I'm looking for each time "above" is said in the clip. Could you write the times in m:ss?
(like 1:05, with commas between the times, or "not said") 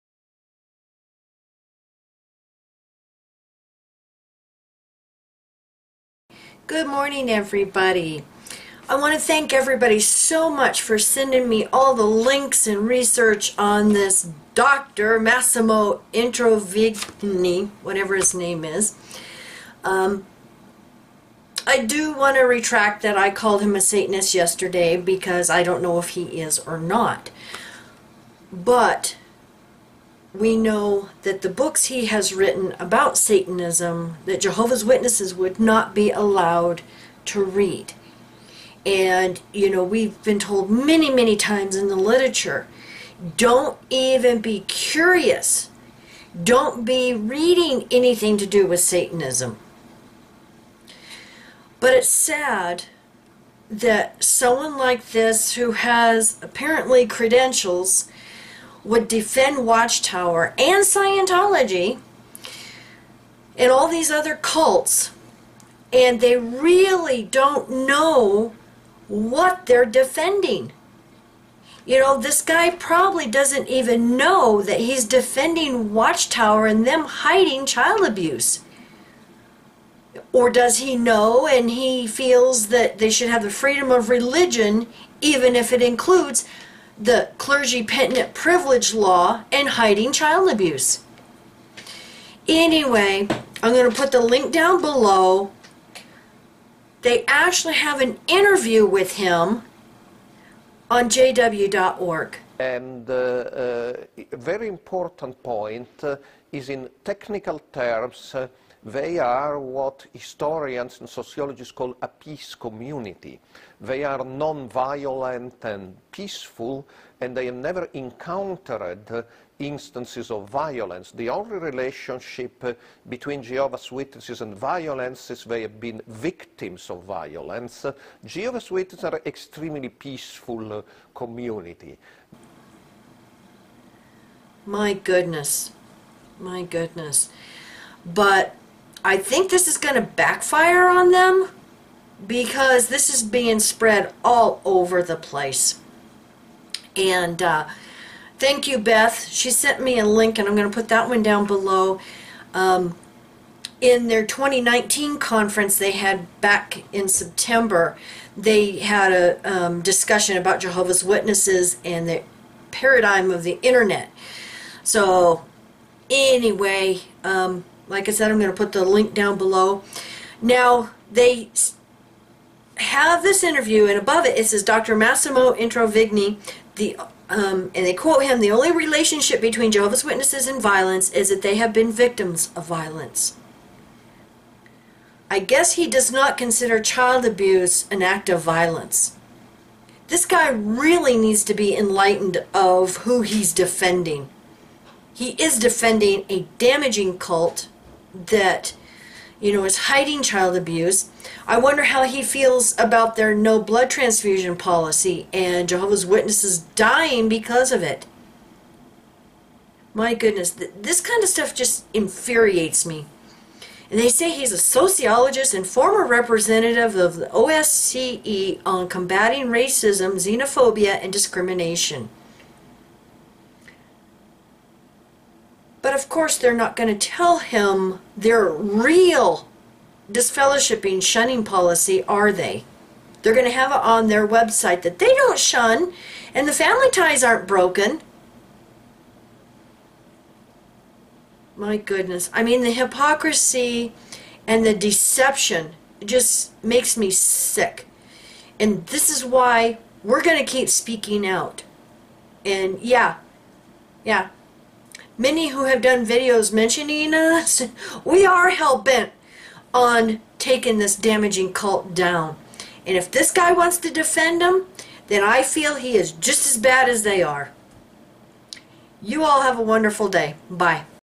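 2:53.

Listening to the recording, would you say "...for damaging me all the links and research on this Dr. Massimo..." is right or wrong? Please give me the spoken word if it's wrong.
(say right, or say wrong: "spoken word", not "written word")
wrong: "sending", not "damaging".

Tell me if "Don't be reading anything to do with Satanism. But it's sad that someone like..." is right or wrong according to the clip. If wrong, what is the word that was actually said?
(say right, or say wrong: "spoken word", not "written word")
right.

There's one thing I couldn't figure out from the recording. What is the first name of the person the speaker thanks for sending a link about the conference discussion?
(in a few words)
Beth.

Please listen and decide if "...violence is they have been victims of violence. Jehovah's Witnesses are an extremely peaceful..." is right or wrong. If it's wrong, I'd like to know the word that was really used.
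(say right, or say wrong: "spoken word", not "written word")
right.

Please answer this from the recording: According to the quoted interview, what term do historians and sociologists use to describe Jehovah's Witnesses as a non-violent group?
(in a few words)
peace community.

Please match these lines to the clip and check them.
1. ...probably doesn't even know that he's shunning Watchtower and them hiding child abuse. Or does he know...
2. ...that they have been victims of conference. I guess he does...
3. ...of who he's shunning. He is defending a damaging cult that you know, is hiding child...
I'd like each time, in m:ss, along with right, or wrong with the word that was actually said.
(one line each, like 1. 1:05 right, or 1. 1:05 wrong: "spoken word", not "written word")
1. 1:12 wrong: "defending", not "shunning"
2. 3:01 wrong: "violence", not "conference"
3. 3:12 wrong: "defending", not "shunning".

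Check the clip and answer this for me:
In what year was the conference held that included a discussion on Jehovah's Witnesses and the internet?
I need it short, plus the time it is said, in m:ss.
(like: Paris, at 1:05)
2019, at 2:34.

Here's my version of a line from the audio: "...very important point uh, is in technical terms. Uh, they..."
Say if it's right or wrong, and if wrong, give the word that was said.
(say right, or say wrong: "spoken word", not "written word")
right.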